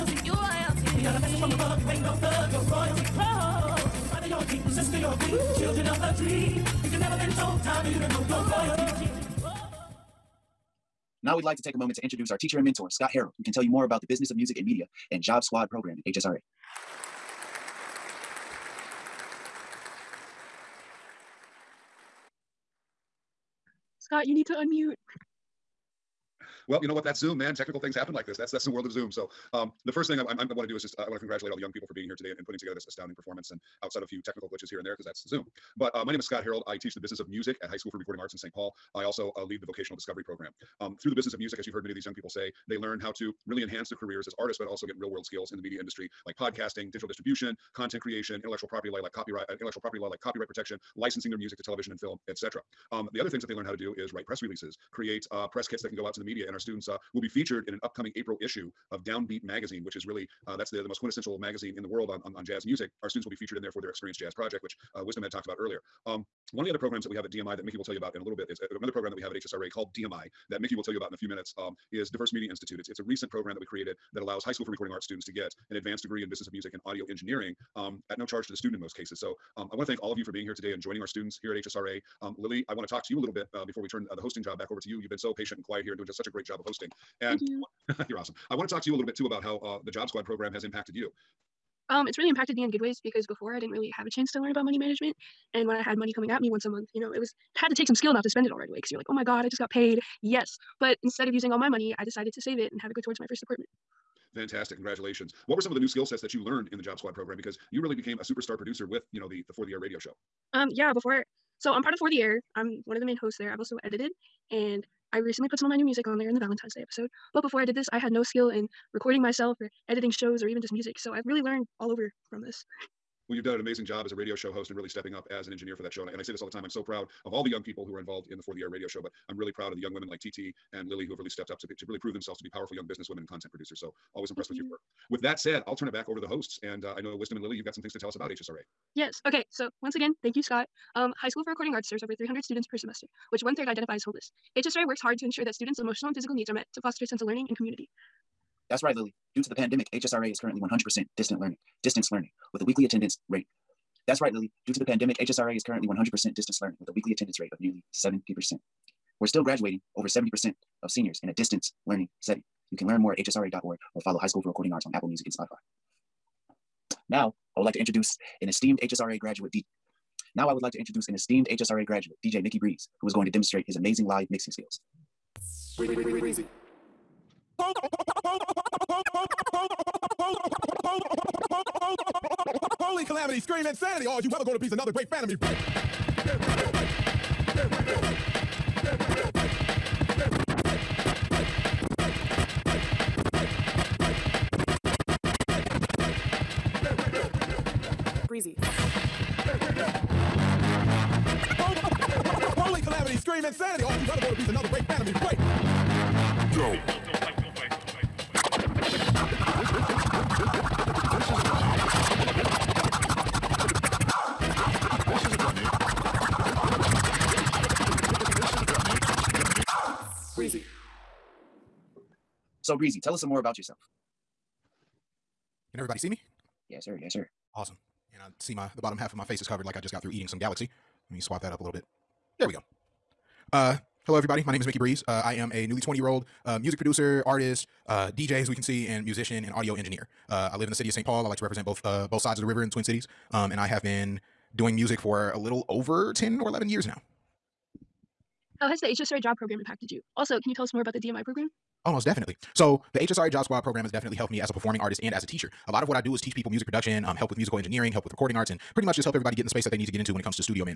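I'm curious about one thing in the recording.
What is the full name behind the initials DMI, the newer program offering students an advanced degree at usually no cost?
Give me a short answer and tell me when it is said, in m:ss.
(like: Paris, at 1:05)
Diverse Media Institute, at 1:12.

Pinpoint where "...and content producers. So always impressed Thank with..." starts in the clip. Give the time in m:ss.
2:13.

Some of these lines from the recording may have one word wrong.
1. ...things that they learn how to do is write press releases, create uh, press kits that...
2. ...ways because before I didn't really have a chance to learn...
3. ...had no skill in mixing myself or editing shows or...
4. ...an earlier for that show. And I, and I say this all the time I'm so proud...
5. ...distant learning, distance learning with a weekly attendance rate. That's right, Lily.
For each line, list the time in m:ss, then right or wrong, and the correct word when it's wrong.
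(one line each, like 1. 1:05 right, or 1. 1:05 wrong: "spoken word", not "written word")
1. 0:53 right
2. 1:32 right
3. 1:57 wrong: "recording", not "mixing"
4. 2:05 wrong: "engineer", not "earlier"
5. 2:31 right.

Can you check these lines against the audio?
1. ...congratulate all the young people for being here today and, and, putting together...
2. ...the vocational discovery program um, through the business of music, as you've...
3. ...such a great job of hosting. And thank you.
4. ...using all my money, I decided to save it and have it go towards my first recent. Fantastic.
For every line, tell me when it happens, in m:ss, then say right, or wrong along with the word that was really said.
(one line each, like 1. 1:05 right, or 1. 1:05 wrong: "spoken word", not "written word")
1. 0:31 right
2. 0:39 right
3. 1:26 right
4. 1:41 wrong: "apartment", not "recent".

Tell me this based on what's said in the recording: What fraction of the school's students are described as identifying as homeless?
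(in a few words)
One third.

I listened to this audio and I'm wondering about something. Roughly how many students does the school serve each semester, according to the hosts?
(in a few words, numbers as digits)
Over 300.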